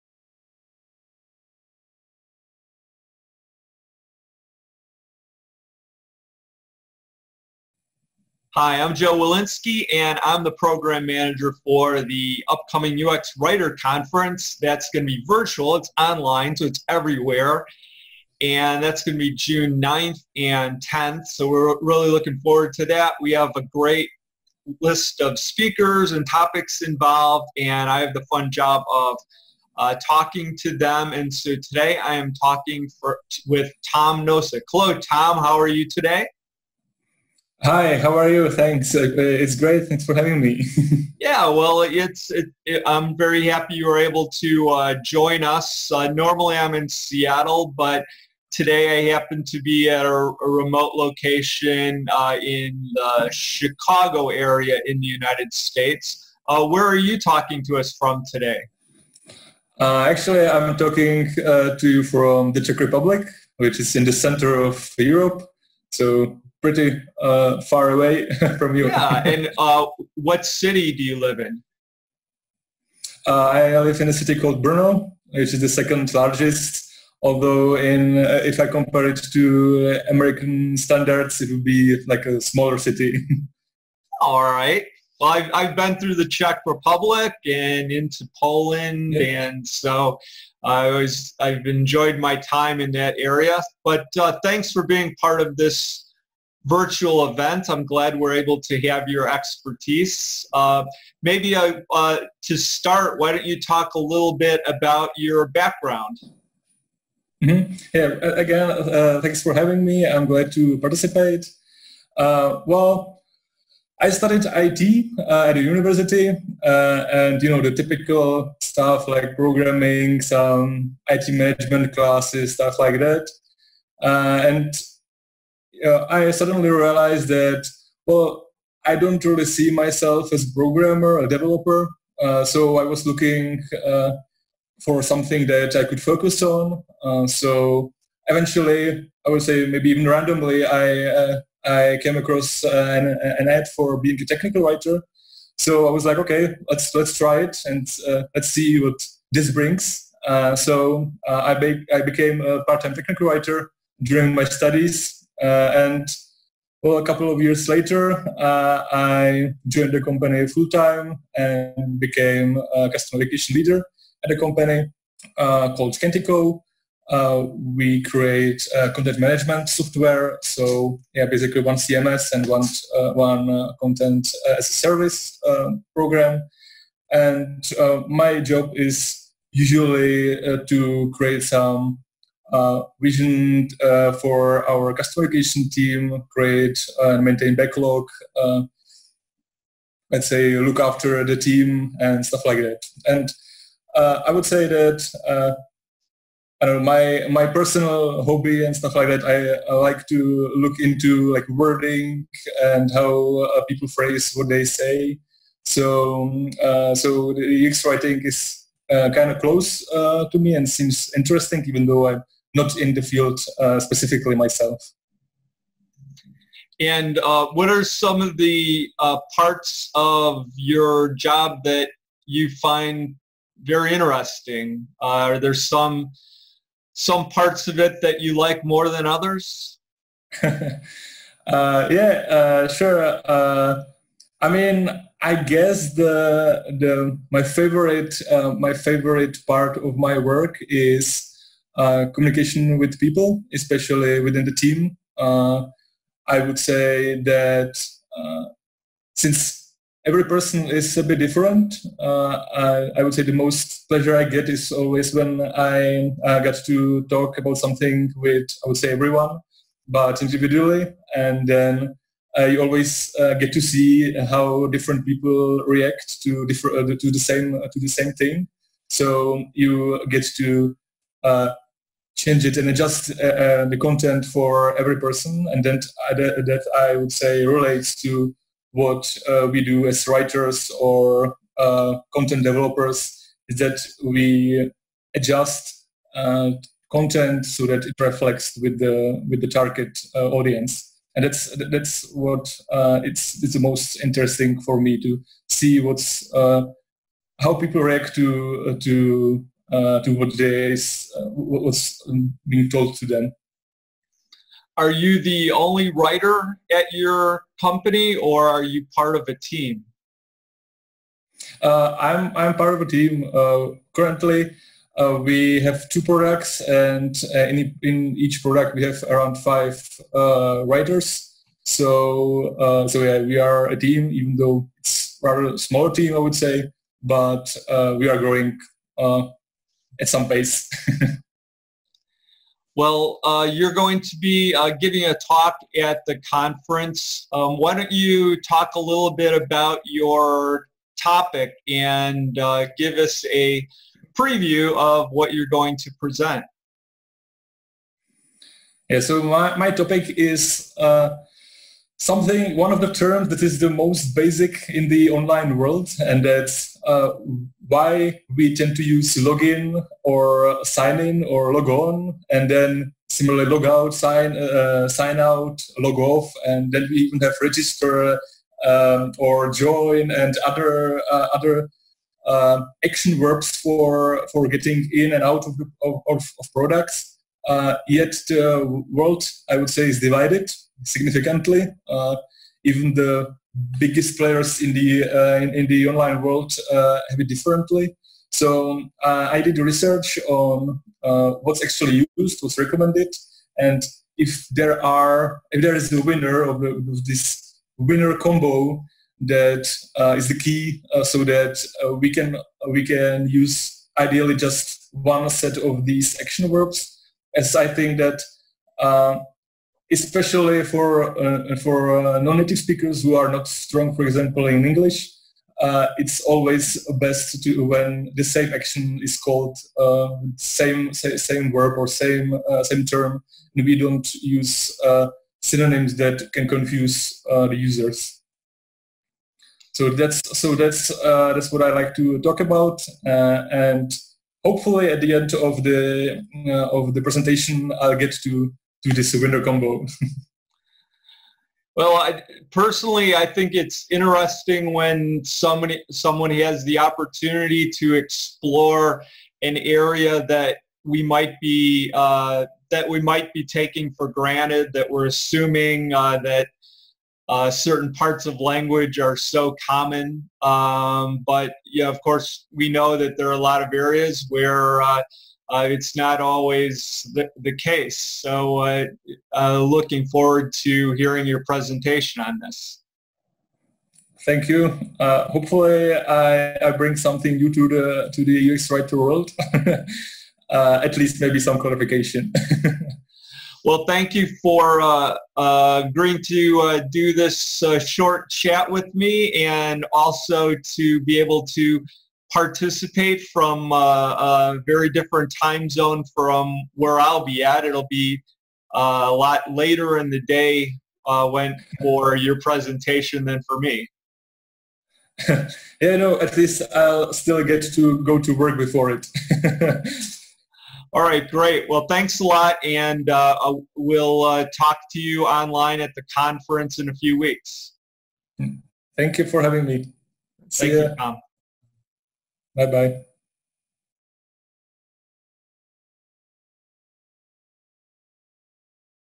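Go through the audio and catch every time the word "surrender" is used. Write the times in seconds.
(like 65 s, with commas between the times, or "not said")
439 s.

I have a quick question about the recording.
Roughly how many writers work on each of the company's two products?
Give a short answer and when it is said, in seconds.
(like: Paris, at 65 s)
5, at 319 s.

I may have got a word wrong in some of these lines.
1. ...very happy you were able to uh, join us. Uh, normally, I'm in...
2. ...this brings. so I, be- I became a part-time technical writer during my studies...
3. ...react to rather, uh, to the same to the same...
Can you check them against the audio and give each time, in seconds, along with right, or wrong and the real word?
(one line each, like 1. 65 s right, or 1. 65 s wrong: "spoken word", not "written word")
1. 43 s right
2. 149 s right
3. 265 s wrong: "differ", not "rather".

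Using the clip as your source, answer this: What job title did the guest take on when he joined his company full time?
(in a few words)
Customer education leader.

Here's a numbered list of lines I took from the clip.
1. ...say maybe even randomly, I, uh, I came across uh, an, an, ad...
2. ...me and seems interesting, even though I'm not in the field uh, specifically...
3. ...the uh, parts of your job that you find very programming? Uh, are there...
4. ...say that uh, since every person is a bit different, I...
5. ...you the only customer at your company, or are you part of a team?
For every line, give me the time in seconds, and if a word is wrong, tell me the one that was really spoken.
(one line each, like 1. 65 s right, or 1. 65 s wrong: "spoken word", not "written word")
1. 139 s right
2. 210 s right
3. 218 s wrong: "interesting", not "programming"
4. 246 s right
5. 304 s wrong: "writer", not "customer".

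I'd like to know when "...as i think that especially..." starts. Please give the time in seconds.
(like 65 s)
407 s.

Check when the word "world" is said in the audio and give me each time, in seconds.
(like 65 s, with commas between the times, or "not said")
355 s, 378 s, 386 s, 478 s.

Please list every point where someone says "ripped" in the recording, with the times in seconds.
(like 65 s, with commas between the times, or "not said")
not said.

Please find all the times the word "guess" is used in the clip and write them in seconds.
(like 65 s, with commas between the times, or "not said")
235 s.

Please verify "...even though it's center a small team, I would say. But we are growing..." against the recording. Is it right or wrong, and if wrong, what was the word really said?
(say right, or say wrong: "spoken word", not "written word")
wrong: "rather", not "center".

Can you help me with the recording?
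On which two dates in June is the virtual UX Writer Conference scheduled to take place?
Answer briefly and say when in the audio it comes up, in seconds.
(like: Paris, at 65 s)
June 9th and 10th, at 19 s.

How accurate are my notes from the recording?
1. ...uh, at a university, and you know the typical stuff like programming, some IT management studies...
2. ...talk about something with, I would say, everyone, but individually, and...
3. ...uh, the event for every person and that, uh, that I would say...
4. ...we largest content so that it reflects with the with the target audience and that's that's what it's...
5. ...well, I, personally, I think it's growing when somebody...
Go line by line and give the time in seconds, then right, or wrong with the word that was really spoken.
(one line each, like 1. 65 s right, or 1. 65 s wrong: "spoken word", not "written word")
1. 115 s wrong: "classes", not "studies"
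2. 257 s right
3. 273 s wrong: "content", not "event"
4. 284 s wrong: "adjust", not "largest"
5. 441 s wrong: "interesting", not "growing".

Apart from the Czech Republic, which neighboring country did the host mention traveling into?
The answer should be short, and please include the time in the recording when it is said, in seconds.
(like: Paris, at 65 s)
Poland, at 88 s.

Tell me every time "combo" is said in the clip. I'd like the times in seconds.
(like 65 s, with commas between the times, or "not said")
398 s, 439 s.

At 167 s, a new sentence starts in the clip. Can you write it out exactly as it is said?
Uh, we create uh, content management software.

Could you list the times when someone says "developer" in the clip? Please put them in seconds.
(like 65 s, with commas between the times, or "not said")
131 s, 282 s.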